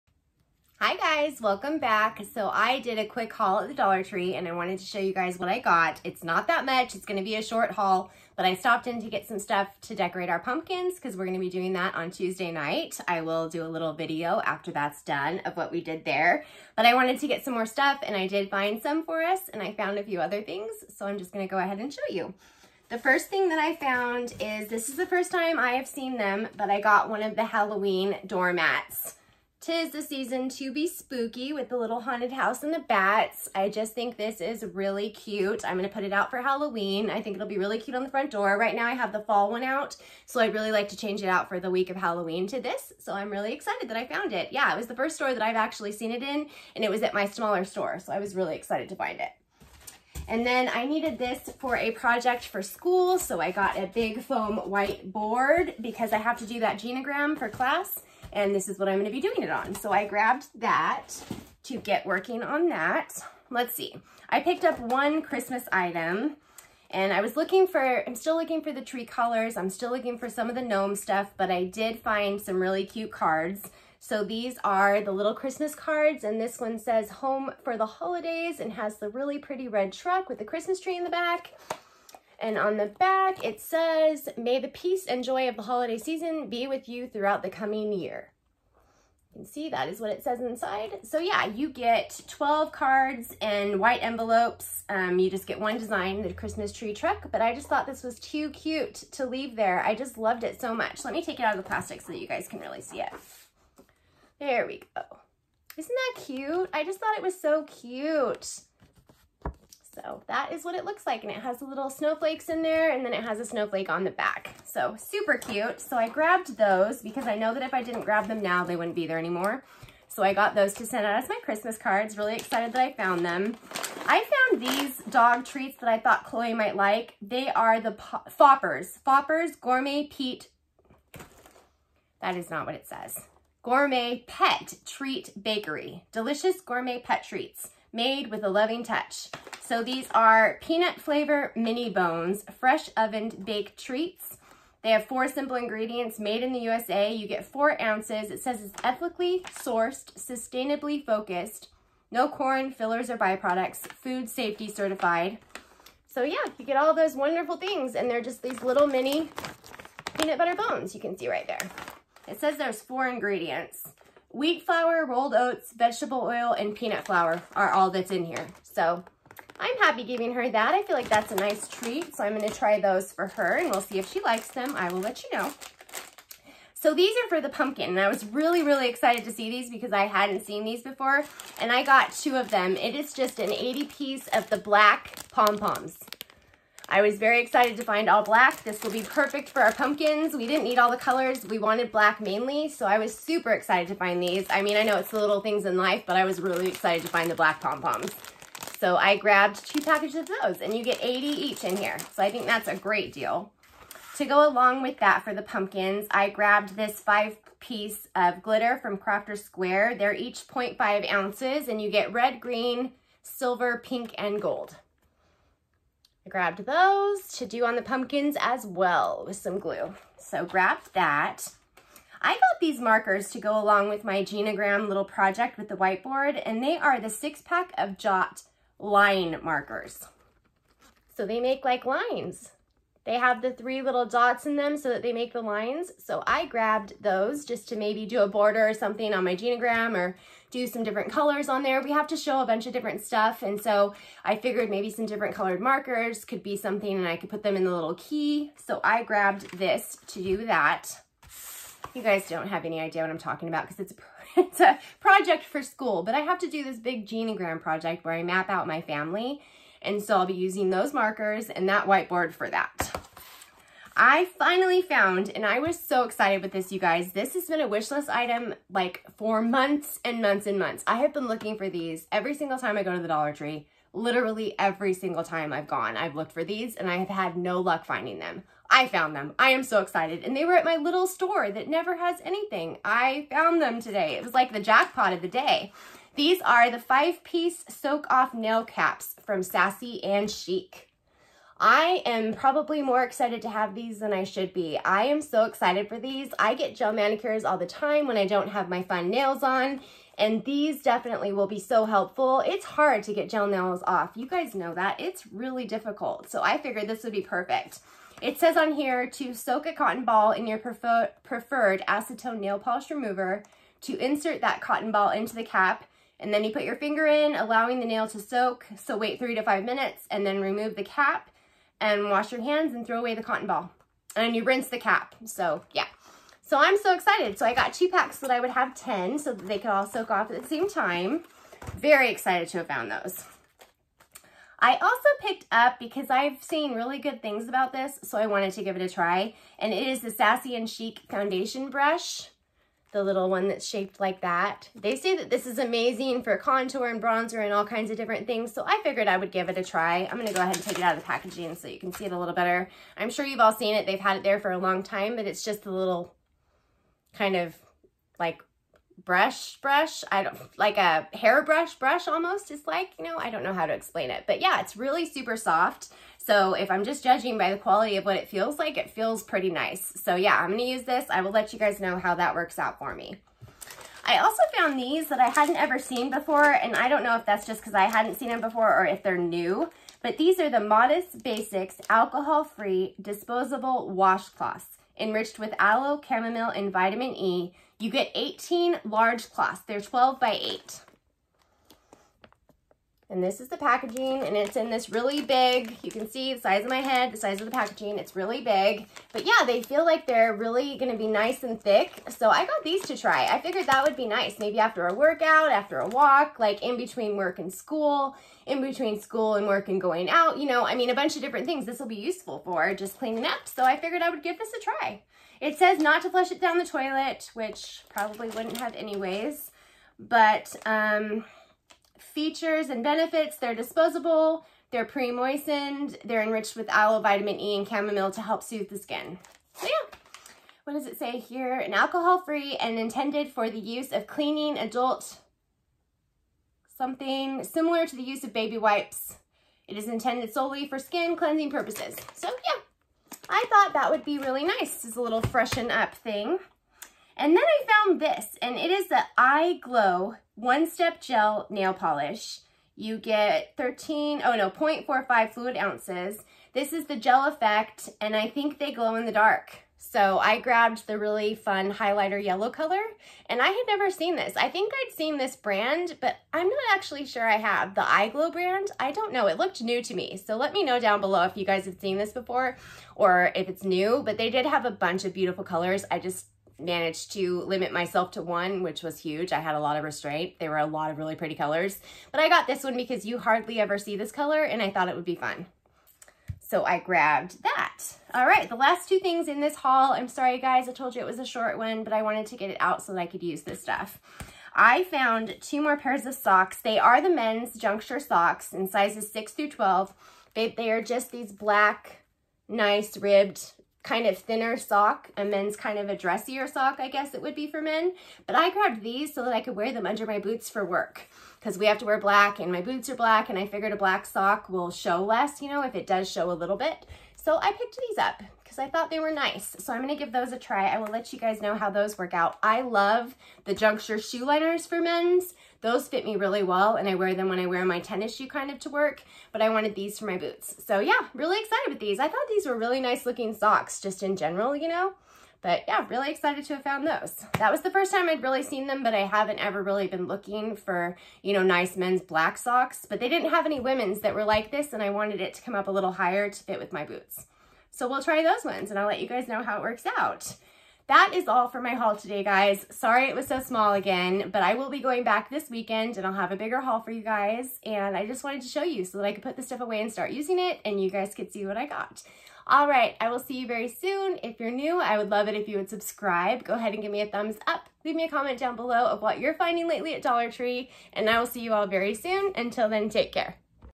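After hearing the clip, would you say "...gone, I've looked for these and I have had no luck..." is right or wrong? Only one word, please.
right.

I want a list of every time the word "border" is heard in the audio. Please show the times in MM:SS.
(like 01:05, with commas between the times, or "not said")
03:58.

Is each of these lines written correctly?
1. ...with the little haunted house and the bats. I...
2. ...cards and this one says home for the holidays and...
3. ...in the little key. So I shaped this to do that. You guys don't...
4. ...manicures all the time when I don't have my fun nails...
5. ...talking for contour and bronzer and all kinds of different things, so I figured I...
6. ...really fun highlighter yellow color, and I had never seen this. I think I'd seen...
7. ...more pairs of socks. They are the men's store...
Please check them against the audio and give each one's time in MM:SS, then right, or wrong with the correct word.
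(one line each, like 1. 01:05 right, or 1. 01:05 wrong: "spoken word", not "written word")
1. 00:31 right
2. 01:15 right
3. 04:07 wrong: "grabbed", not "shaped"
4. 04:56 right
5. 05:45 wrong: "amazing", not "talking"
6. 07:40 right
7. 08:15 wrong: "juncture", not "store".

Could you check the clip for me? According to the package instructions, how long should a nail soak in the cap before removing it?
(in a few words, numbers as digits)
3 to 5 minutes.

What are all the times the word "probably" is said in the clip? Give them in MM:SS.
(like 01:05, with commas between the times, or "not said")
04:52, 06:57.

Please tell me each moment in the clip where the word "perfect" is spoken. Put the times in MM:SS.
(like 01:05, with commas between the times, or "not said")
03:09, 05:07.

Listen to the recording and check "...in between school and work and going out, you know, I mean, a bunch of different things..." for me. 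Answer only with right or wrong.
right.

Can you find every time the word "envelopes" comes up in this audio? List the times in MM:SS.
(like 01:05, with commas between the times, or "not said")
01:34.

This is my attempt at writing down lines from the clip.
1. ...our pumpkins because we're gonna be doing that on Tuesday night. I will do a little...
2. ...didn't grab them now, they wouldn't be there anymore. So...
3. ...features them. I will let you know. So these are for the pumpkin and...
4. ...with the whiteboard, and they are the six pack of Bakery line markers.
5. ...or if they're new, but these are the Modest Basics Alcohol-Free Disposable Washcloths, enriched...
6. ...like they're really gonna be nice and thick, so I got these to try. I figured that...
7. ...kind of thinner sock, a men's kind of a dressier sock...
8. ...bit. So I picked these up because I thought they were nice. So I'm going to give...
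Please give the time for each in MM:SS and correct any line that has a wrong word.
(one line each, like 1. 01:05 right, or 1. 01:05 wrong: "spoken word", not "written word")
1. 00:10 right
2. 01:57 right
3. 02:54 wrong: "likes", not "features"
4. 03:45 wrong: "Jot", not "Bakery"
5. 06:18 right
6. 06:39 right
7. 08:23 right
8. 08:36 right.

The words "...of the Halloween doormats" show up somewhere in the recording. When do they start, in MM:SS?
00:27.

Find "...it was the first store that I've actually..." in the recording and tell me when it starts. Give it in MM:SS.
00:44.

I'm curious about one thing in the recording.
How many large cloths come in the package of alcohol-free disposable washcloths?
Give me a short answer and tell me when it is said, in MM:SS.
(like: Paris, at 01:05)
18, at 06:28.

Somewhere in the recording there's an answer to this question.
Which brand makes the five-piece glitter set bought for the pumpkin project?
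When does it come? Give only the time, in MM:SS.
03:28.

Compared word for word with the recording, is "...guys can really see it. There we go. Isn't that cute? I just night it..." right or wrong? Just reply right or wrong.
wrong.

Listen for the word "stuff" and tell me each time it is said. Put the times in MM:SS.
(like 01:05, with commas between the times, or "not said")
00:09, 00:17, 01:10, 04:03, 08:13, 09:19.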